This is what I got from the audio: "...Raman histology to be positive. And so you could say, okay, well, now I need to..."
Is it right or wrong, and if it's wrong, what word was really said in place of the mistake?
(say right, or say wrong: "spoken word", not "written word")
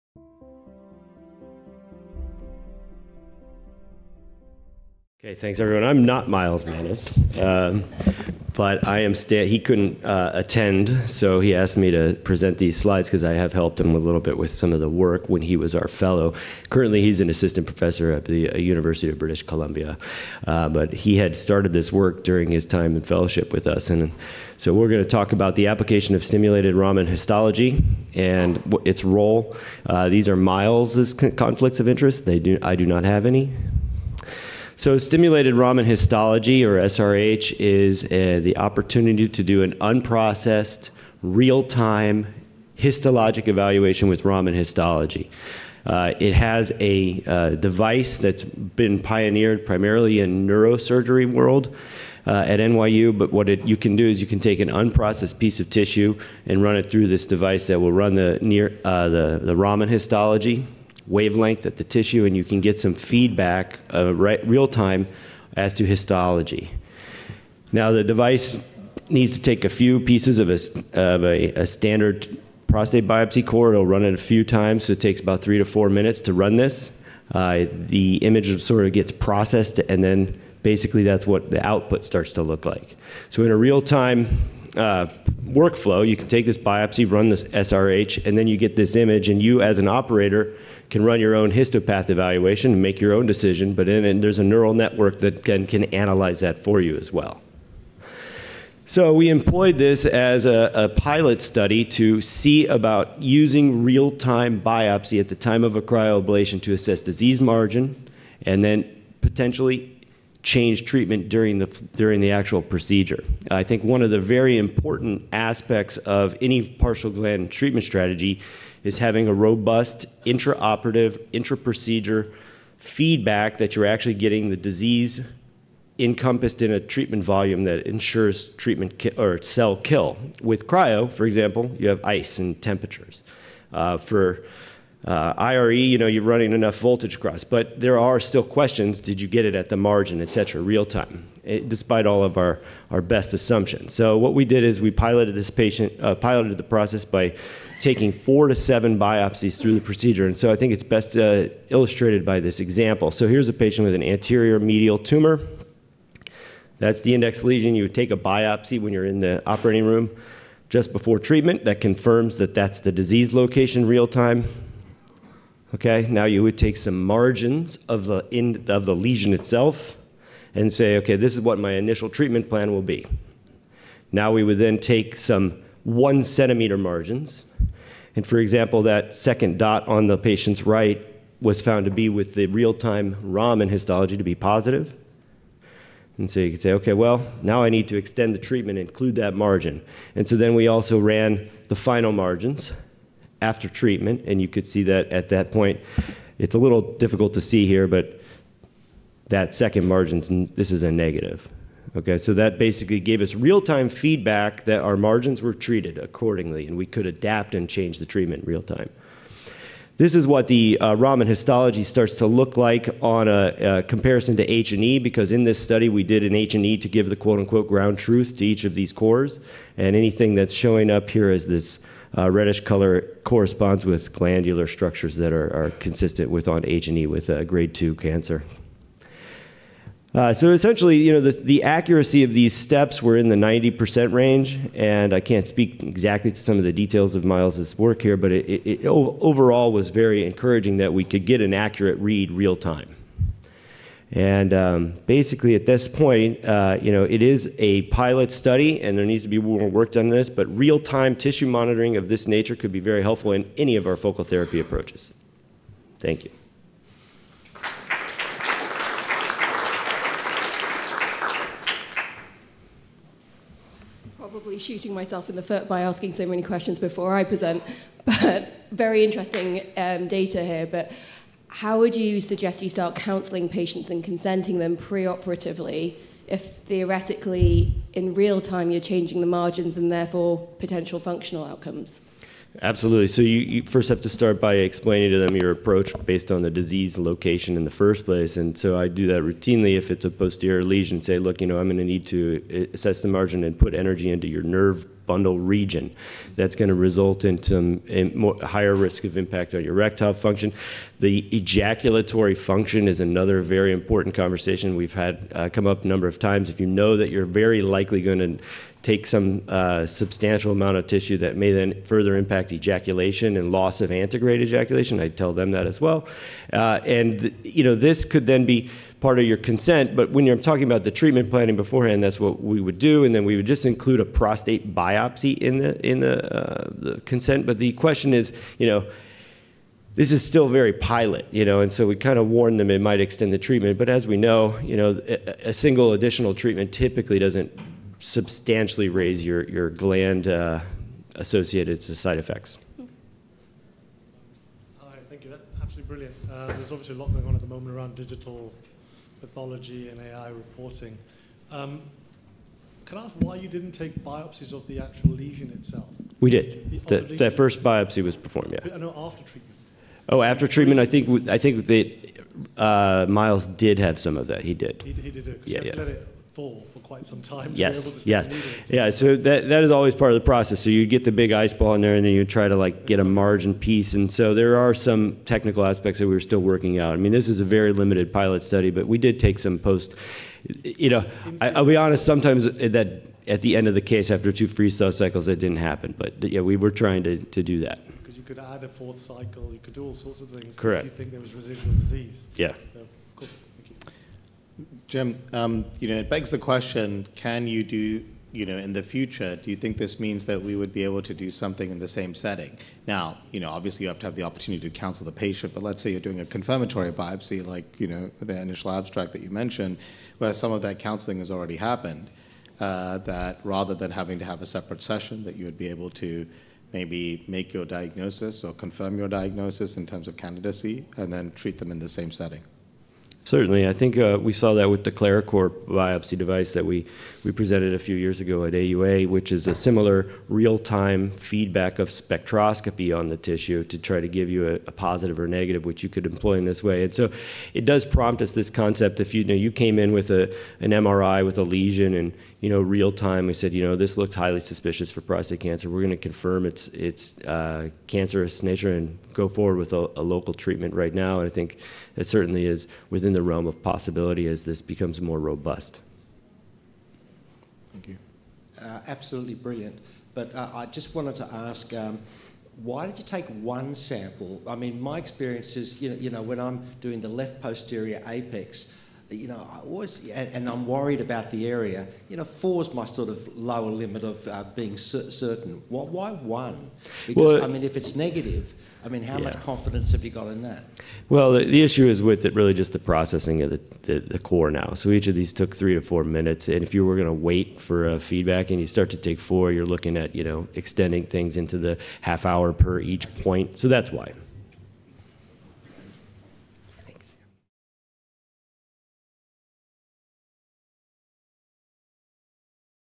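right.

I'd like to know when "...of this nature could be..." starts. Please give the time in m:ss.
4:11.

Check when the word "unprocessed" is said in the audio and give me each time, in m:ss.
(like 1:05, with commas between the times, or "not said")
0:39, 0:54.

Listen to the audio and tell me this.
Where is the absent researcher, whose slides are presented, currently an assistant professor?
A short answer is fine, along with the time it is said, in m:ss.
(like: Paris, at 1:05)
University of British Columbia, at 0:18.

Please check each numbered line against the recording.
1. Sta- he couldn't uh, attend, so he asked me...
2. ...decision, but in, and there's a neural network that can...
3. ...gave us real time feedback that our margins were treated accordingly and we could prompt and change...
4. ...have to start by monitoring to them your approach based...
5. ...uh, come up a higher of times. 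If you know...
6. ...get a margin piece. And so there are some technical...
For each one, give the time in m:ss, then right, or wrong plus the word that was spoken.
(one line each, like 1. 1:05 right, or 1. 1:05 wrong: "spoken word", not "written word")
1. 0:09 right
2. 1:33 right
3. 3:22 wrong: "adapt", not "prompt"
4. 4:43 wrong: "explaining", not "monitoring"
5. 5:05 wrong: "number", not "higher"
6. 6:12 right.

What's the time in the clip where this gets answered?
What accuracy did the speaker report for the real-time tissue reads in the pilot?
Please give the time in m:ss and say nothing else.
3:53.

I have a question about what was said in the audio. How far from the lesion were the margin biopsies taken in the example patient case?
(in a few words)
1 centimeter.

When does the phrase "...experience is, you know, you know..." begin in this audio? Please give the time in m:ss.
7:44.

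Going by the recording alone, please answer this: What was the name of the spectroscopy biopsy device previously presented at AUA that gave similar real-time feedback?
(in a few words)
ClariCore.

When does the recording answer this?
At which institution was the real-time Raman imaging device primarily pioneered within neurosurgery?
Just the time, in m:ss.
0:52.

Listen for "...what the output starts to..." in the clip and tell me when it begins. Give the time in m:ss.
1:21.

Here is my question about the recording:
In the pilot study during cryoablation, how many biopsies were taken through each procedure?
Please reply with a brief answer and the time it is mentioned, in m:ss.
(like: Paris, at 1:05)
4 to 7, at 2:28.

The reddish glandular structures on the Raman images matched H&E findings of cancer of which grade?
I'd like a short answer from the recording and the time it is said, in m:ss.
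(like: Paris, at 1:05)
grade 2, at 3:47.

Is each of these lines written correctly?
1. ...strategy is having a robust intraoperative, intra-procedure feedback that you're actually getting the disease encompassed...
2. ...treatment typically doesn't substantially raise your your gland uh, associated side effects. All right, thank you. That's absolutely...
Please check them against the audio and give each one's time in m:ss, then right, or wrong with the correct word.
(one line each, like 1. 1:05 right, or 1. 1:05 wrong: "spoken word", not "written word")
1. 1:57 right
2. 5:36 right.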